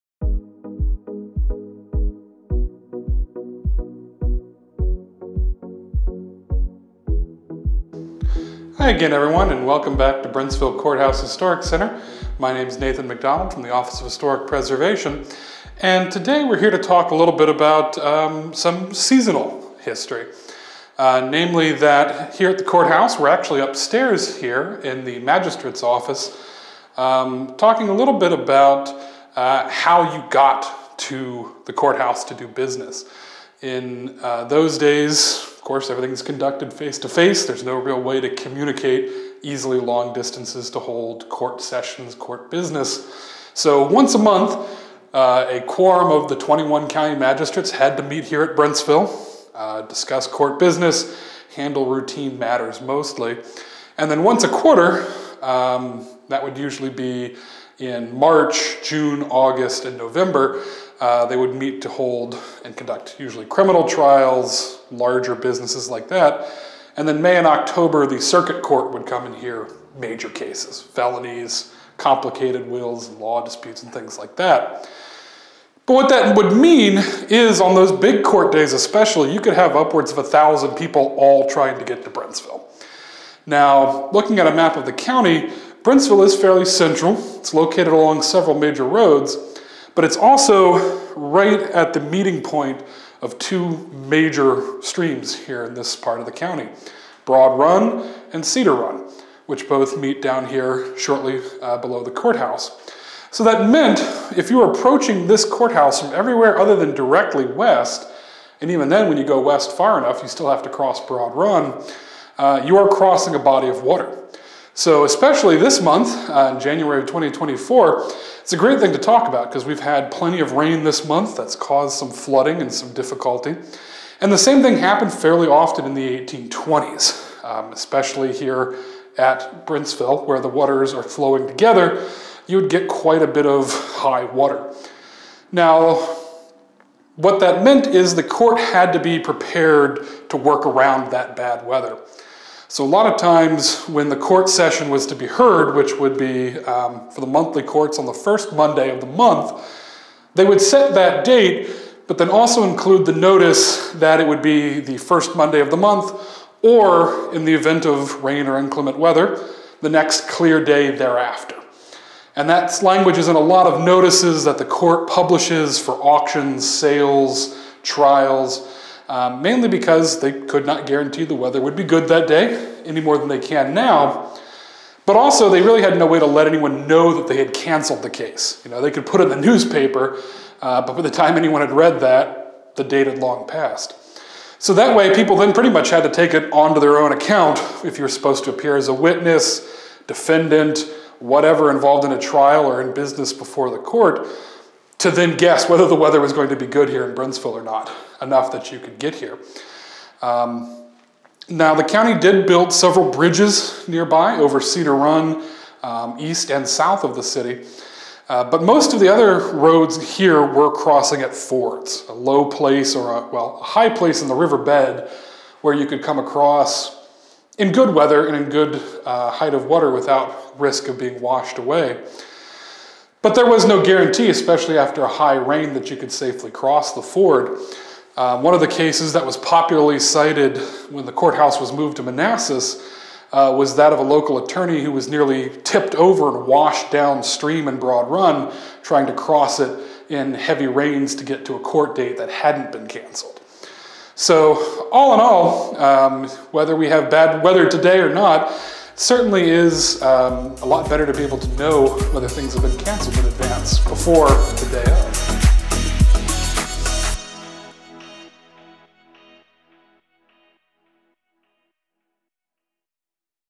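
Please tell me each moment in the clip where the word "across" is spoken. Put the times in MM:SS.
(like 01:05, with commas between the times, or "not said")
03:36.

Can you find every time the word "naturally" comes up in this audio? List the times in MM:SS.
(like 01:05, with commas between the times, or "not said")
not said.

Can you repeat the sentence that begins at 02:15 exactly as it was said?
Now, what that meant is the court had to be prepared to work around that bad weather.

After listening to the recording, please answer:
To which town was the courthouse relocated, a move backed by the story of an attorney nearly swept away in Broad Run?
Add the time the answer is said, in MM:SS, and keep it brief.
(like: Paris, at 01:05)
Manassas, at 03:52.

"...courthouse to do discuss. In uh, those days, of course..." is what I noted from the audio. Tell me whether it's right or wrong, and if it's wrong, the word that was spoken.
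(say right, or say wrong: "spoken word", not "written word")
wrong: "business", not "discuss".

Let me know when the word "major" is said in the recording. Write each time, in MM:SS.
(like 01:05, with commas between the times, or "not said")
01:09, 01:28, 01:34.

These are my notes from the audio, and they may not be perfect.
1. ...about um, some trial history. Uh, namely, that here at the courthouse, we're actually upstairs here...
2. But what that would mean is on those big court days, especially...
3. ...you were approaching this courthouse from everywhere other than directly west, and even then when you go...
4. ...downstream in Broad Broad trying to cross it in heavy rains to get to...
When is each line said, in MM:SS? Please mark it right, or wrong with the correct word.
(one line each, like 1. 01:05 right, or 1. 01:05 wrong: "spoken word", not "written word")
1. 00:17 wrong: "seasonal", not "trial"
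2. 01:15 right
3. 01:44 right
4. 03:56 wrong: "Run", not "Broad".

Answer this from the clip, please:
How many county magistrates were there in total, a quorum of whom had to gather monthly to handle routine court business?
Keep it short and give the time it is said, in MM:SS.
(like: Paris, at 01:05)
21, at 00:46.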